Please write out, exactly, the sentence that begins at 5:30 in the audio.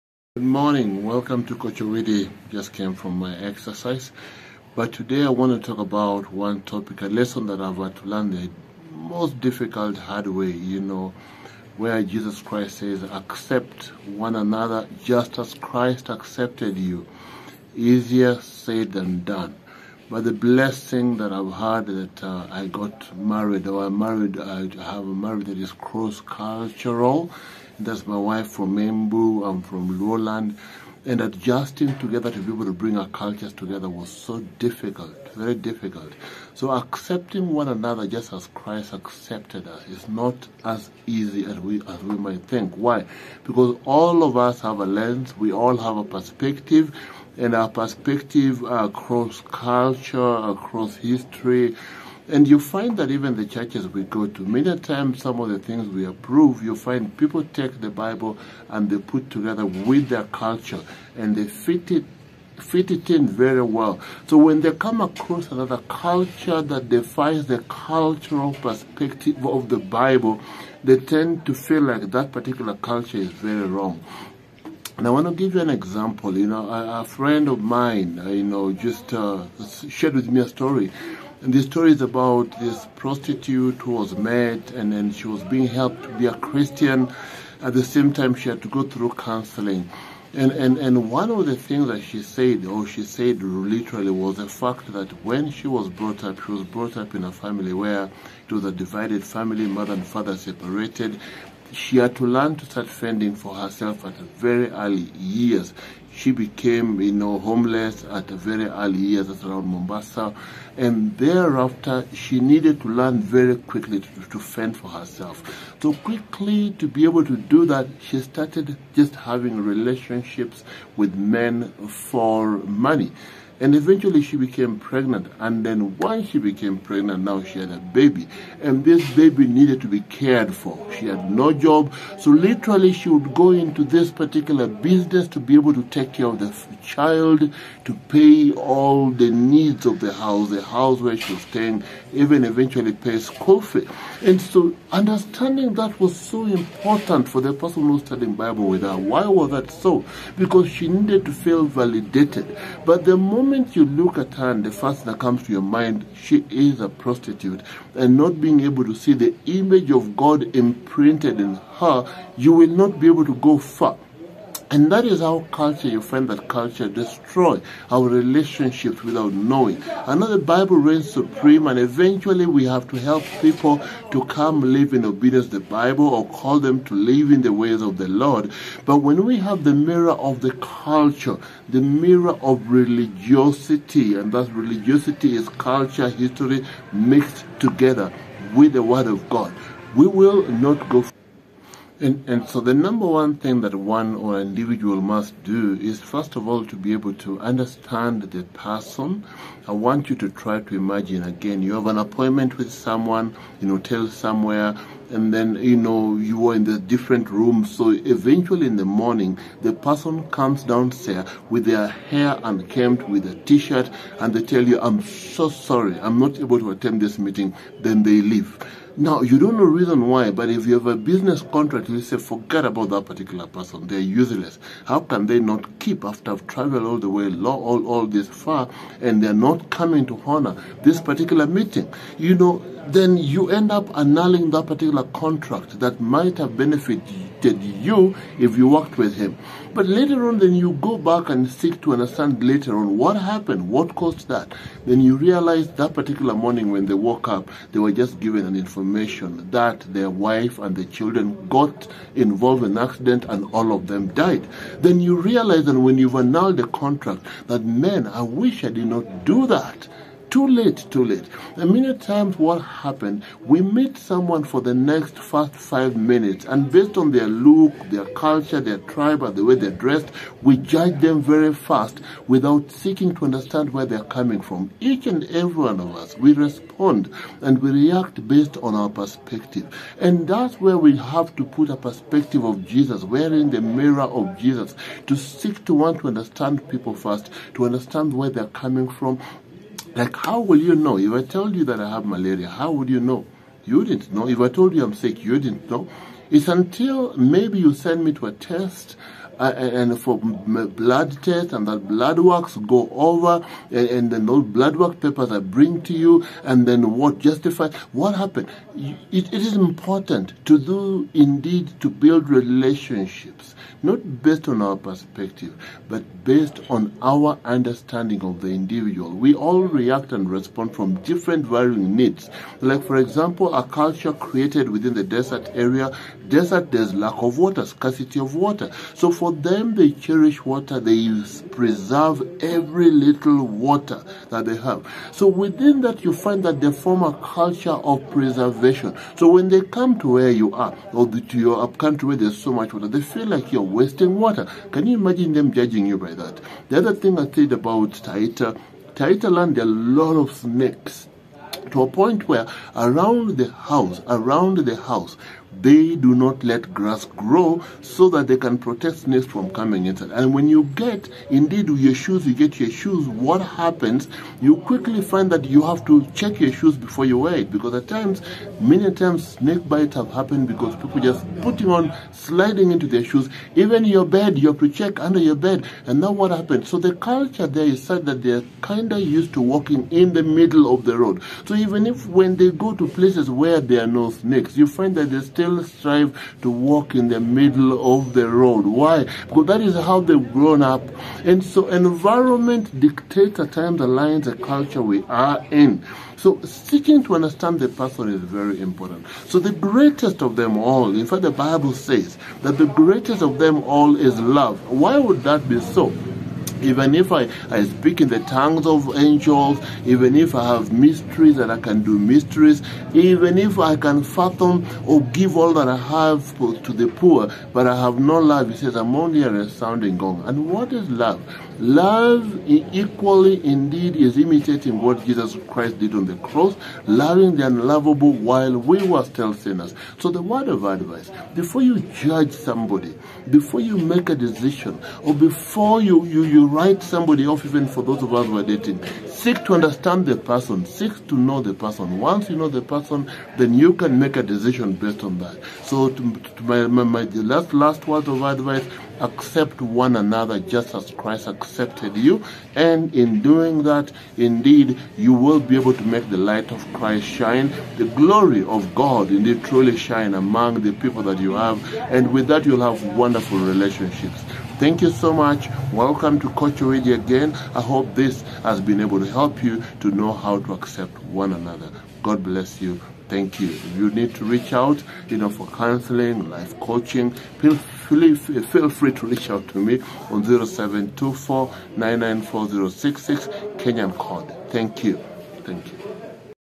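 They preserve every little water that they have.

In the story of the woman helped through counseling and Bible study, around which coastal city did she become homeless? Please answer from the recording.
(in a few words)
Mombasa.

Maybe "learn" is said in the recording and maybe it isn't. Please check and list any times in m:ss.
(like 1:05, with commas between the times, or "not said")
0:08, 1:42, 1:52.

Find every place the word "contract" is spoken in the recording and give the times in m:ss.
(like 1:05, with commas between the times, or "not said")
3:41, 3:55, 4:16.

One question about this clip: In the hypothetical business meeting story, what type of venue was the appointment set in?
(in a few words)
a hotel.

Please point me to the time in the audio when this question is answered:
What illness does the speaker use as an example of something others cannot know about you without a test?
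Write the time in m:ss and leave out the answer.
4:52.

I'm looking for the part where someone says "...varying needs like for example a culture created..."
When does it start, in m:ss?
5:21.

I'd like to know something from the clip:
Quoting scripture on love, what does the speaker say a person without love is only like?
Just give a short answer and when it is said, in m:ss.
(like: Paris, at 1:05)
a sounding gong, at 6:59.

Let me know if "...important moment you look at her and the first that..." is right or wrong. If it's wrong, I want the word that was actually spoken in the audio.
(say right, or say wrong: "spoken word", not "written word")
wrong: "moment", not "important".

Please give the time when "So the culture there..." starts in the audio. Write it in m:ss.
6:16.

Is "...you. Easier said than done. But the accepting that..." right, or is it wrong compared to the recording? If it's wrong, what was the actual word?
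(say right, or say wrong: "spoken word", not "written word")
wrong: "blessing", not "accepting".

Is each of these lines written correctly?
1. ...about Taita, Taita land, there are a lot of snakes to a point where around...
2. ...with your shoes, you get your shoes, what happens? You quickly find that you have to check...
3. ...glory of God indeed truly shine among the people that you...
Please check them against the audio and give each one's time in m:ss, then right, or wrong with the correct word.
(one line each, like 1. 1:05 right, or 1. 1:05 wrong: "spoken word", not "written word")
1. 5:47 right
2. 6:01 right
3. 7:37 right.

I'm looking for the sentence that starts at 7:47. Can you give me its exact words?
I hope this has been able to help you to know how to accept one another.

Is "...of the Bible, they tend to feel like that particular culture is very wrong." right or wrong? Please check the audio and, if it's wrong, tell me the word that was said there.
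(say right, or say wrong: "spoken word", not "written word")
right.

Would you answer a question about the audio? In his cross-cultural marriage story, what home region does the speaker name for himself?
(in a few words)
Luoland.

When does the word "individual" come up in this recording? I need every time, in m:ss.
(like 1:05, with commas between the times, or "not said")
3:14, 5:18.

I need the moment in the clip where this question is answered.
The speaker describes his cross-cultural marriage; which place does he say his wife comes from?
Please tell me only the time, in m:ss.
0:28.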